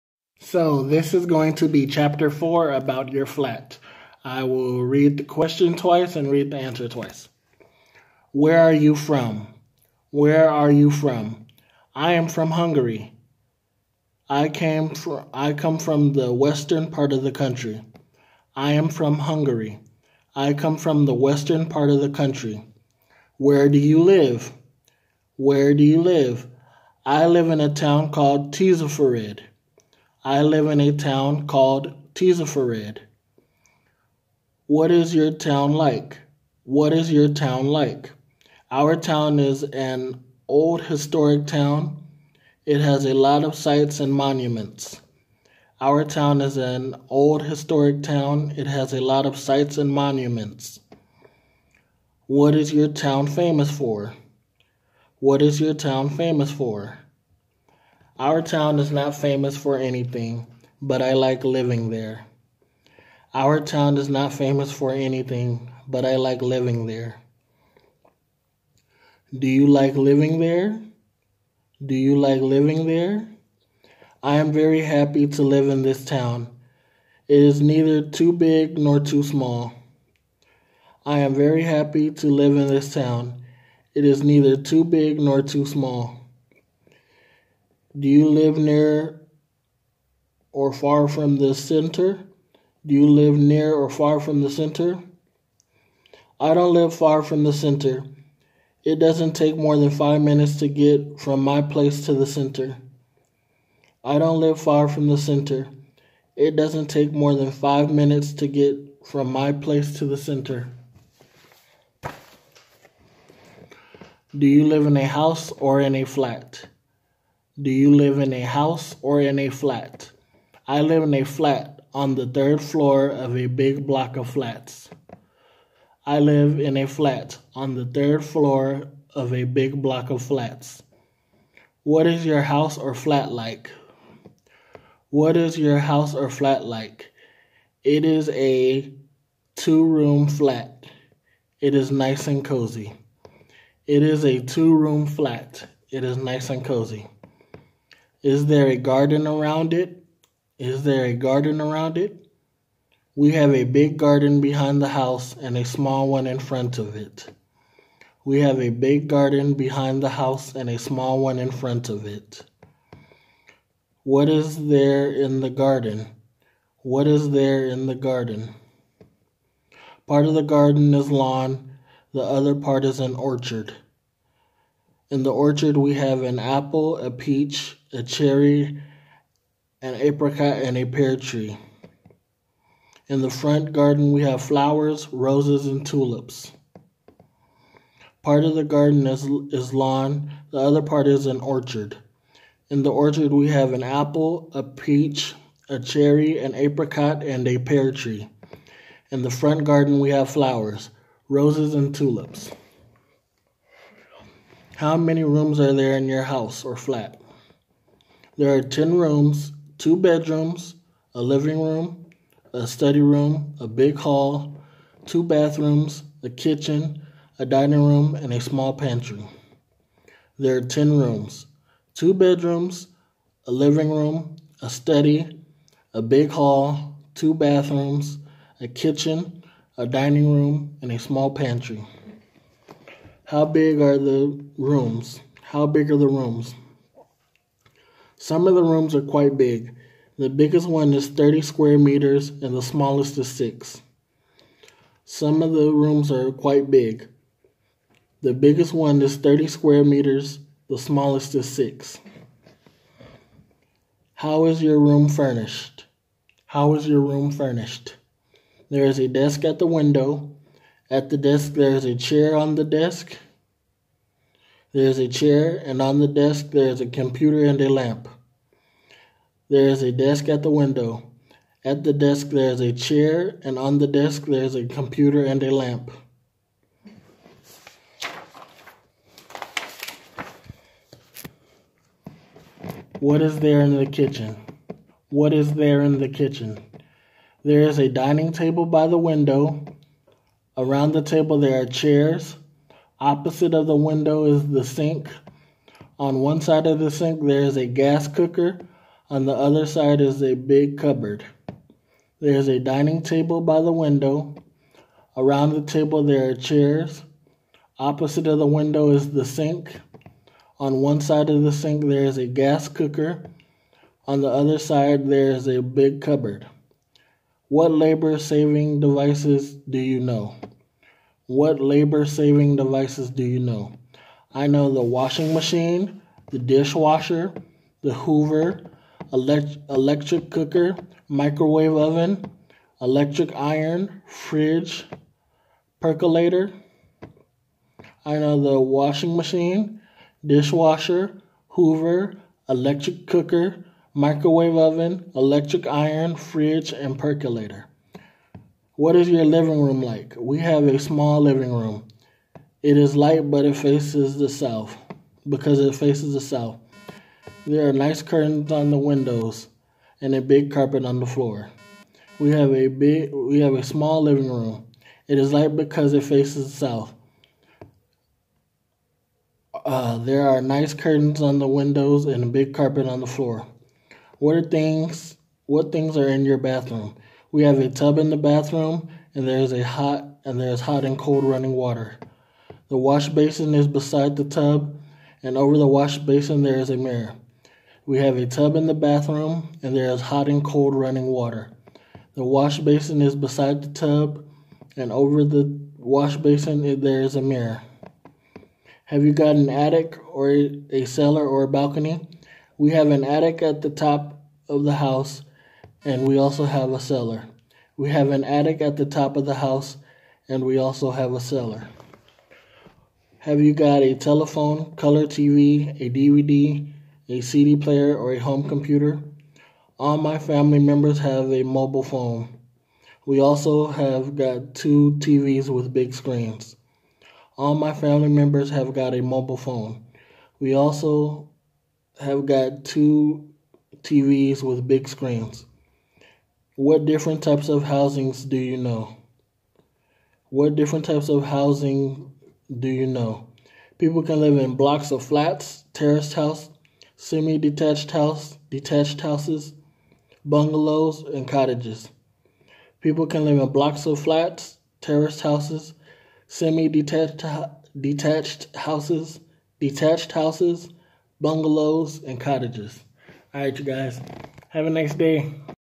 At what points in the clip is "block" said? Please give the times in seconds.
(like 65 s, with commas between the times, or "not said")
123 s, 129 s, 444 s, 453 s.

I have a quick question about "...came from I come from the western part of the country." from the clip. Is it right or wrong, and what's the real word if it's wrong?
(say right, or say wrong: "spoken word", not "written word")
right.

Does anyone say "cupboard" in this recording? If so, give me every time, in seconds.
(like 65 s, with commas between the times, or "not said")
300 s, 316 s.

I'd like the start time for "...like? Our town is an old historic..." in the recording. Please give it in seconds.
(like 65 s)
37 s.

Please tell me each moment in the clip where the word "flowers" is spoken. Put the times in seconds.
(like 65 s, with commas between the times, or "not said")
184 s, 200 s.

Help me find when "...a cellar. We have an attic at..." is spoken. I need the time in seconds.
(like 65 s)
406 s.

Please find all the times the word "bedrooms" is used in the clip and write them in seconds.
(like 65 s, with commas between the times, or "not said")
209 s, 222 s.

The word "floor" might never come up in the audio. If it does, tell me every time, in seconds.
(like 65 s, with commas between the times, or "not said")
122 s, 128 s, 361 s, 373 s.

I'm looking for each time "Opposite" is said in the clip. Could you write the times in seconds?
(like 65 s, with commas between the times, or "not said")
292 s, 307 s.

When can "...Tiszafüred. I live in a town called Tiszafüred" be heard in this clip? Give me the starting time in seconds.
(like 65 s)
28 s.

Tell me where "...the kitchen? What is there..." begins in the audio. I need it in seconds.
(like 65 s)
283 s.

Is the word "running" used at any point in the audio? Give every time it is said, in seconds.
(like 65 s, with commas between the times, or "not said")
381 s, 390 s.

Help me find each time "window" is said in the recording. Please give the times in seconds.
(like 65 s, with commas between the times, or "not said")
259 s, 270 s, 288 s, 293 s, 303 s, 308 s, 358 s, 371 s.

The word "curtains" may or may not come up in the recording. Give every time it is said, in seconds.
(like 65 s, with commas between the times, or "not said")
358 s, 370 s.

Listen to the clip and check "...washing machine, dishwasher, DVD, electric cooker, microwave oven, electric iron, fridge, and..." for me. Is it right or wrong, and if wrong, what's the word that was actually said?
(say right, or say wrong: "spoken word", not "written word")
wrong: "Hoover", not "DVD".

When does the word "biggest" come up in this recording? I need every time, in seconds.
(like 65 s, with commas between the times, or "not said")
240 s, 248 s.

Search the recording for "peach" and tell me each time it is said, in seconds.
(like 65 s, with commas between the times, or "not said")
177 s, 194 s.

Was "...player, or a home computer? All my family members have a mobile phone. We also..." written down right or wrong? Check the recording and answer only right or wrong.
right.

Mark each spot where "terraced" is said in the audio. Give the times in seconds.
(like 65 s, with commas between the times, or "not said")
445 s, 454 s.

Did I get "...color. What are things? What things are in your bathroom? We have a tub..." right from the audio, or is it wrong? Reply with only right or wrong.
wrong.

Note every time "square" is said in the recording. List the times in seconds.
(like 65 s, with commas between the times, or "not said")
241 s, 249 s.